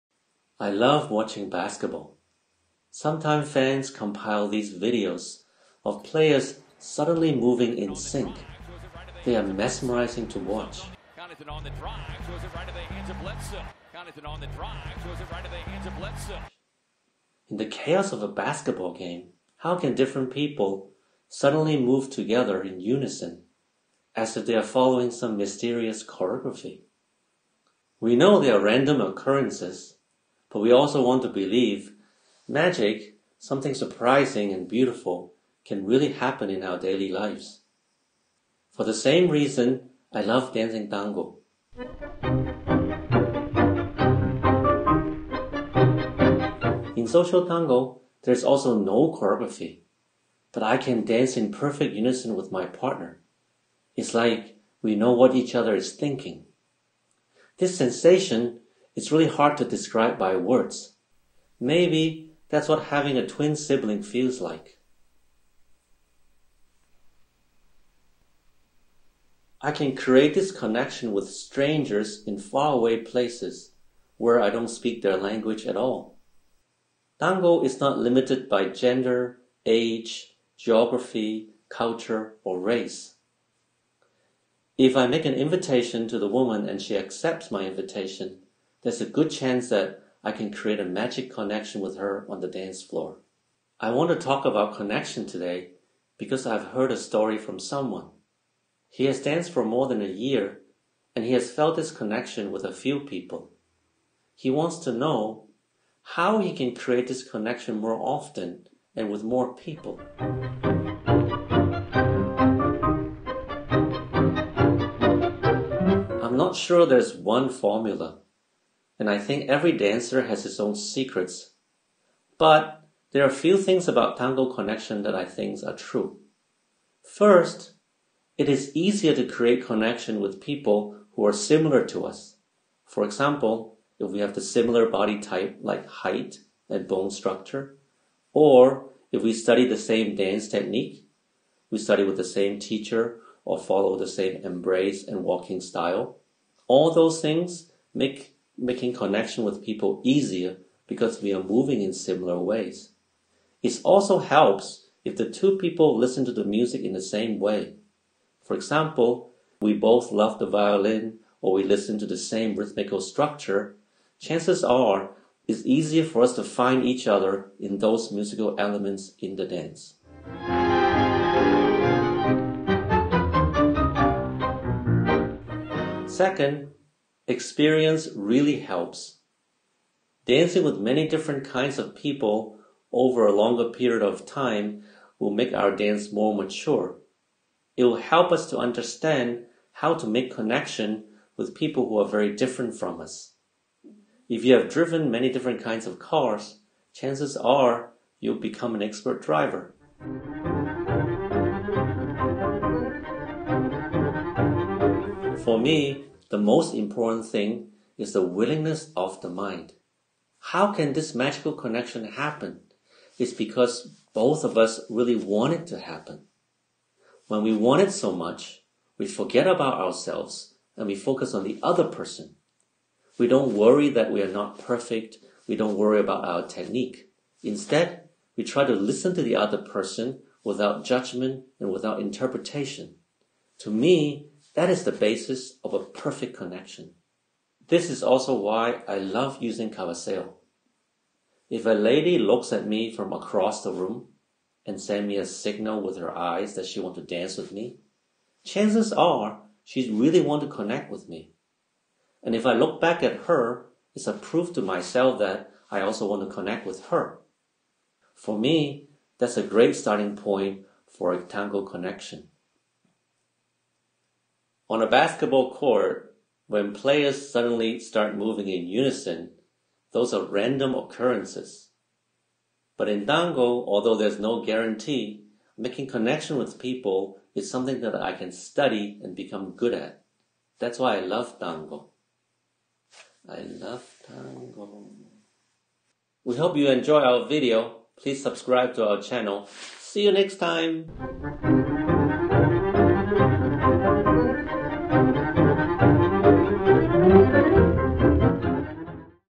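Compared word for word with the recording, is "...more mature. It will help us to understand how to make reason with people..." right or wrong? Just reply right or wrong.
wrong.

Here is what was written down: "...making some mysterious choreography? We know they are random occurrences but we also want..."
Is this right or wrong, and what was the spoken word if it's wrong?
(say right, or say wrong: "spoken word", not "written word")
wrong: "following", not "making".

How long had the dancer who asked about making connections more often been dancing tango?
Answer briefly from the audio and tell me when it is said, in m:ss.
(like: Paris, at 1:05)
More than a year, at 1:39.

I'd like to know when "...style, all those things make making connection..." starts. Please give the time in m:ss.
2:25.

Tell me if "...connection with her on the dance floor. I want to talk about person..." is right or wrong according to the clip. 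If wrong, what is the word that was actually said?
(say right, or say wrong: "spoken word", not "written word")
wrong: "connection", not "person".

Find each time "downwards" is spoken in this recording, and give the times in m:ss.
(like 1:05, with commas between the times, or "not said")
not said.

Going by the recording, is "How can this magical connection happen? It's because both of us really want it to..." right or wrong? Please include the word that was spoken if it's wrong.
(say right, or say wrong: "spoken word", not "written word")
right.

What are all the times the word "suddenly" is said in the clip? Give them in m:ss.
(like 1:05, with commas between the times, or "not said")
0:06, 0:21, 4:27.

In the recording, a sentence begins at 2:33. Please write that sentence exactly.
It also helps if the two people listen to the music in the same way.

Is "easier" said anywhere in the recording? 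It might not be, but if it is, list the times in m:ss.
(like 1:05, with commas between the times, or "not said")
2:08, 2:30, 2:45.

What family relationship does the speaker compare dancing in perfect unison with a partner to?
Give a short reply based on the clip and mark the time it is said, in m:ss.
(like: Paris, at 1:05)
Twin sibling, at 1:03.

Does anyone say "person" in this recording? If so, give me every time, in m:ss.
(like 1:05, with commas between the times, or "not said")
3:41, 3:49.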